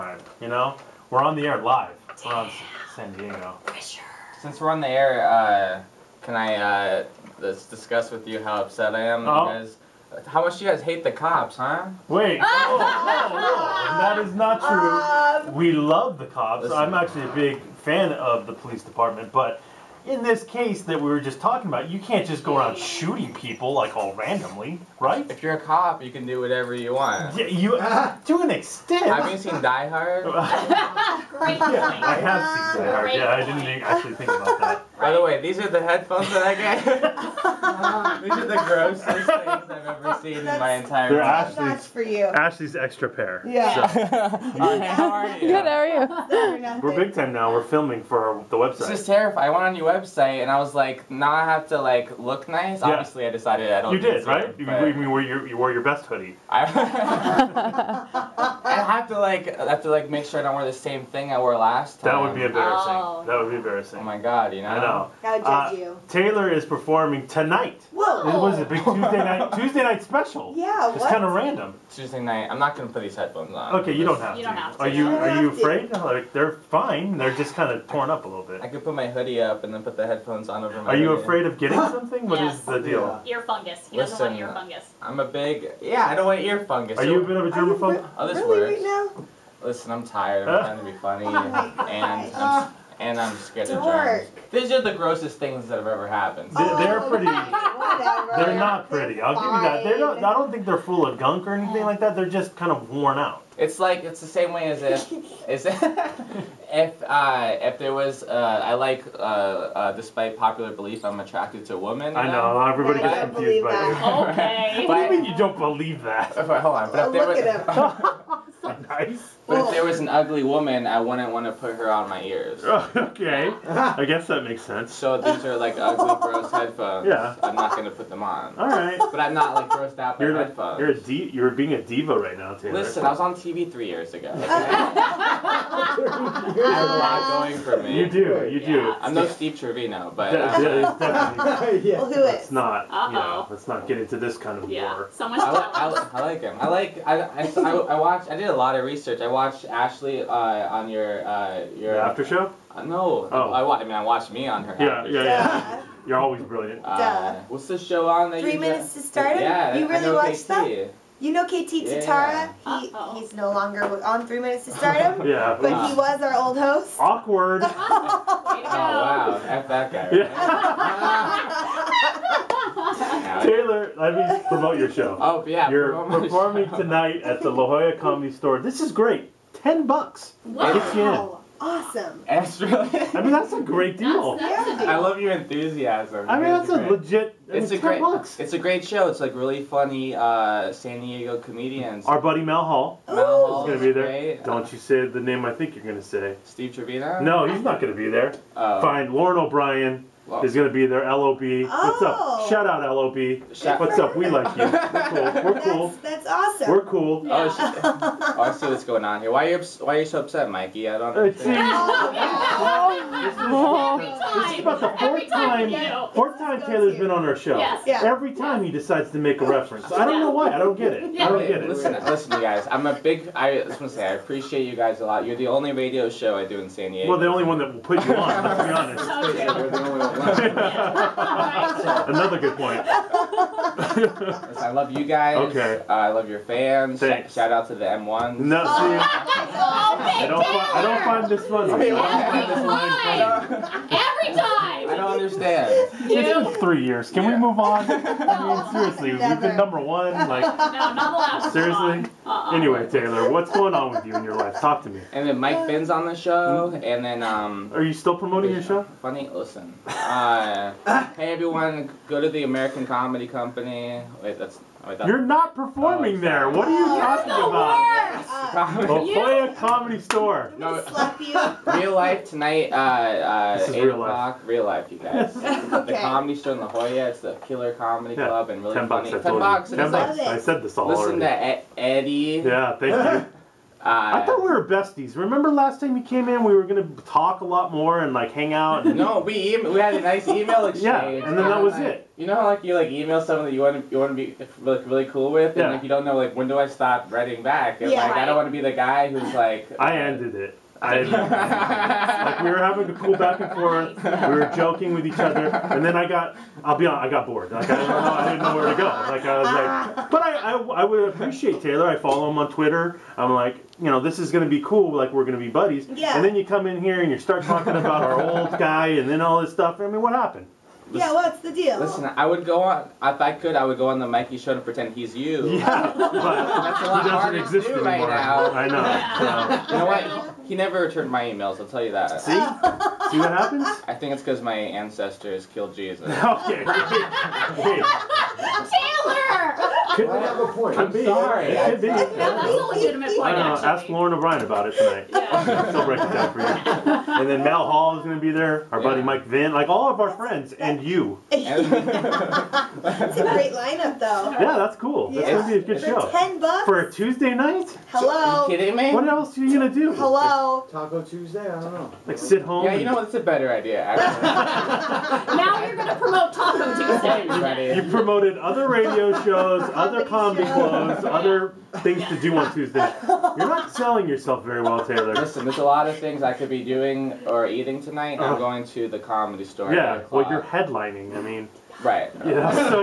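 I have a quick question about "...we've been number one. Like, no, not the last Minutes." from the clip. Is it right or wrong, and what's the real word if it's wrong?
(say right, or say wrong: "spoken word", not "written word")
wrong: "Seriously", not "Minutes".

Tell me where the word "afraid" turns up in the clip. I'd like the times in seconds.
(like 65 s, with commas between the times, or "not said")
75 s, 81 s.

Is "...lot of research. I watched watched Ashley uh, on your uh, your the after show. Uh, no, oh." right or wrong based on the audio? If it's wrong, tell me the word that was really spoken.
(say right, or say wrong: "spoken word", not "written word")
right.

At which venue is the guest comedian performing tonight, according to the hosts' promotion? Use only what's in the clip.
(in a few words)
La Jolla Comedy Store.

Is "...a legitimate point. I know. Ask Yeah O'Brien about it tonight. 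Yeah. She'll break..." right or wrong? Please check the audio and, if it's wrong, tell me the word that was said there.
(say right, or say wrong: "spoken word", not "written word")
wrong: "Lauren", not "Yeah".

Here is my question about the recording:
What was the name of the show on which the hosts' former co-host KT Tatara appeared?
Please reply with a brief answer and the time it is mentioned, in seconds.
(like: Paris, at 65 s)
Three Minutes to Stardom, at 164 s.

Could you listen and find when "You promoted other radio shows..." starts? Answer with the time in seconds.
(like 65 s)
367 s.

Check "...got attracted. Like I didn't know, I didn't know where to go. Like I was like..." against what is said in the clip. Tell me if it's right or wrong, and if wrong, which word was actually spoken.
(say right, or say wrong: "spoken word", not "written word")
wrong: "bored", not "attracted".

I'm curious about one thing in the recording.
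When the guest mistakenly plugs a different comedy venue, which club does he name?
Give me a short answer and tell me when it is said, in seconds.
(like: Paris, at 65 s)
American Comedy Company, at 262 s.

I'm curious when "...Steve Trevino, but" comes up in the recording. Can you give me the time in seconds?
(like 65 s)
139 s.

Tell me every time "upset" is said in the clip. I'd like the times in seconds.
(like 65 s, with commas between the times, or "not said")
8 s, 210 s.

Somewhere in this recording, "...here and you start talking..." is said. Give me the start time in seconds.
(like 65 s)
316 s.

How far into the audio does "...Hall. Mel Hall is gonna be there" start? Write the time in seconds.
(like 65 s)
192 s.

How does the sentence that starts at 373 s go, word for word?
You're not selling yourself very well, Taylor.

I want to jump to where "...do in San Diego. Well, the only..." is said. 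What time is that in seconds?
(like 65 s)
226 s.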